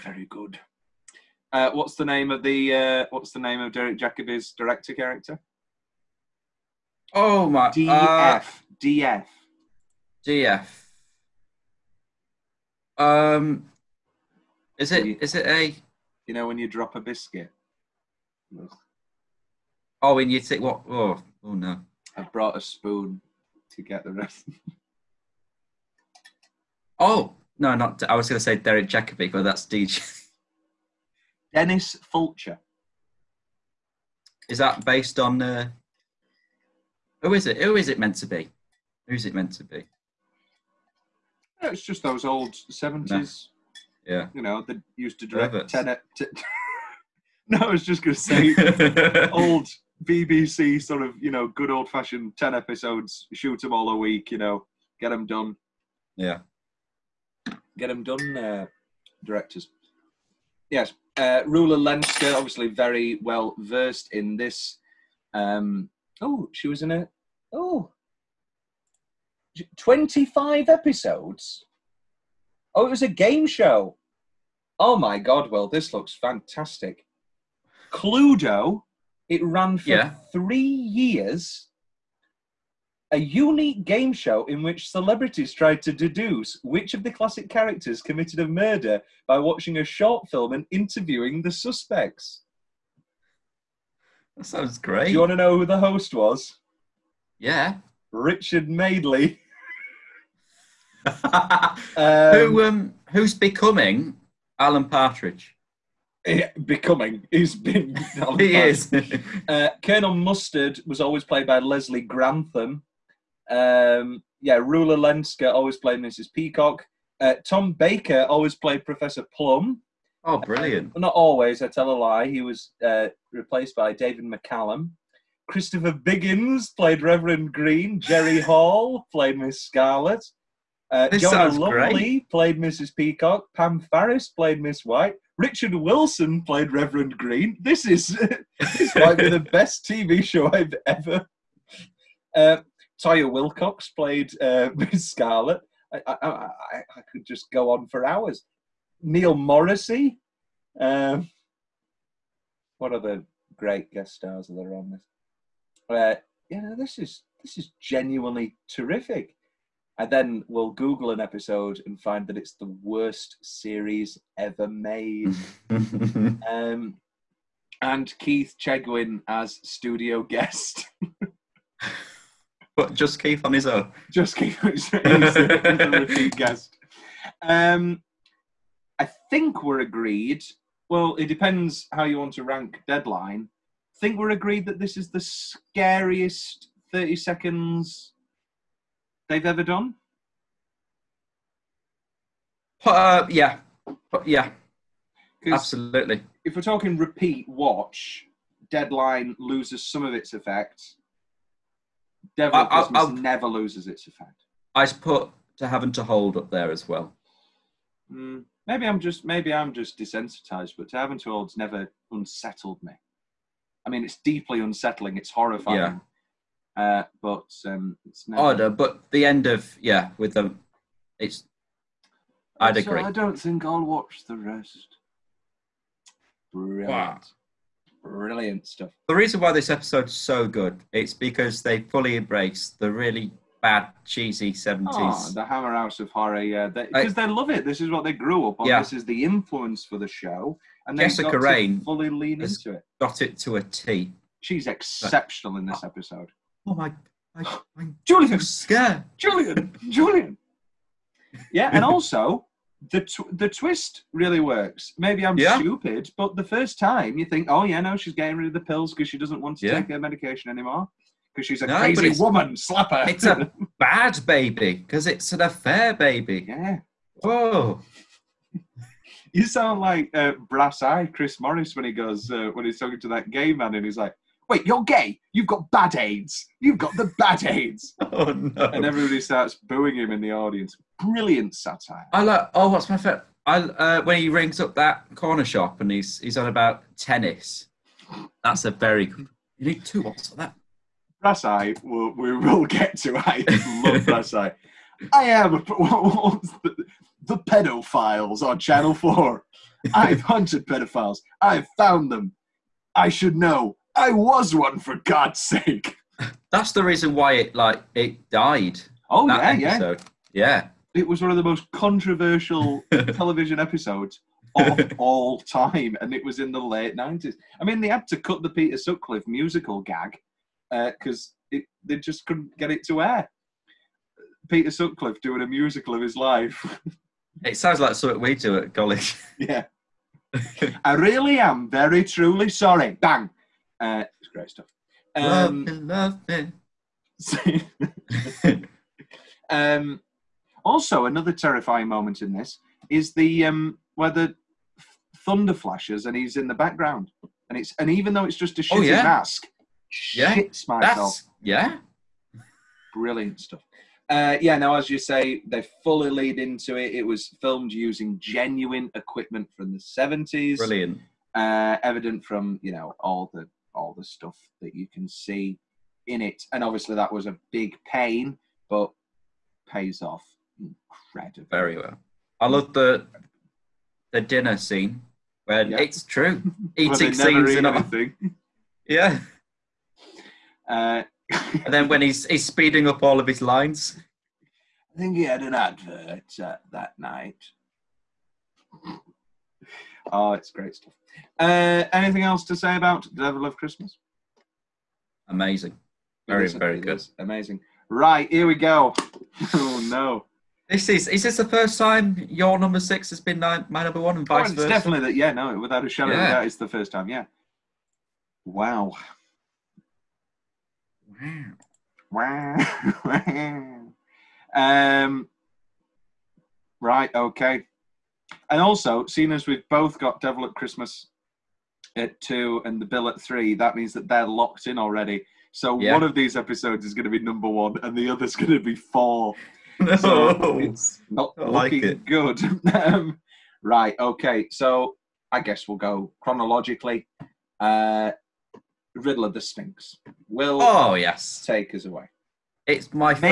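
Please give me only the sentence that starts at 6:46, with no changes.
of a doubt, it's the first time.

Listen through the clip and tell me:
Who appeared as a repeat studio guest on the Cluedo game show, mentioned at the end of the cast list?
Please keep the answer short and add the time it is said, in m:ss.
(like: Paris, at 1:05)
Keith Chegwin, at 2:48.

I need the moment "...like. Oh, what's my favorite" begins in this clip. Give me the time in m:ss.
4:42.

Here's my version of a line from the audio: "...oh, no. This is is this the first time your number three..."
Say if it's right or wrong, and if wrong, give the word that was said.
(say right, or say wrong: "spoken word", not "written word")
wrong: "six", not "three".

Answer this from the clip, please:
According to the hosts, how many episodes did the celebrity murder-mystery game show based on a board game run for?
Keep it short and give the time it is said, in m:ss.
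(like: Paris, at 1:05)
25, at 1:09.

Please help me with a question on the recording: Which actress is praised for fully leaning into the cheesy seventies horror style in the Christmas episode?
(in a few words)
Jessica Raine.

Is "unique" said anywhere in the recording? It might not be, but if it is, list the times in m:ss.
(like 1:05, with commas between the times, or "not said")
1:23.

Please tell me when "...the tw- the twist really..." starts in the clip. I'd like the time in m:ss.
4:12.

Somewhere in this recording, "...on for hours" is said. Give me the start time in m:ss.
2:27.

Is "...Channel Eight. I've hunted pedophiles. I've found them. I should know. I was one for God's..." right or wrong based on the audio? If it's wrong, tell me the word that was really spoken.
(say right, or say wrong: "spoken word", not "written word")
wrong: "Four", not "Eight".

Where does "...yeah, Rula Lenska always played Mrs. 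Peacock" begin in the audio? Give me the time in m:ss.
1:54.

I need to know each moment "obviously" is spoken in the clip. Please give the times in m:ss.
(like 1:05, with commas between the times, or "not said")
1:02, 6:06.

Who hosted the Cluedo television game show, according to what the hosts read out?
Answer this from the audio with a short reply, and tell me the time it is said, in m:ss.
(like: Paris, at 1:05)
Richard Madeley, at 1:38.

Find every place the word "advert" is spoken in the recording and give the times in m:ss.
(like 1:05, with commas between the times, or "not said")
6:25.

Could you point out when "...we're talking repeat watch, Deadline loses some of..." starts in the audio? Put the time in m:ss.
3:16.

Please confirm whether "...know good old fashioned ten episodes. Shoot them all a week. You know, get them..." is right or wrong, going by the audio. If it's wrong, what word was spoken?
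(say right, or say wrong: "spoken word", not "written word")
right.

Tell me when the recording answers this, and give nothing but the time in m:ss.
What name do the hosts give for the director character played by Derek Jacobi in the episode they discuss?
0:31.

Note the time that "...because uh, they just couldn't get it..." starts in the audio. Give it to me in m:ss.
5:20.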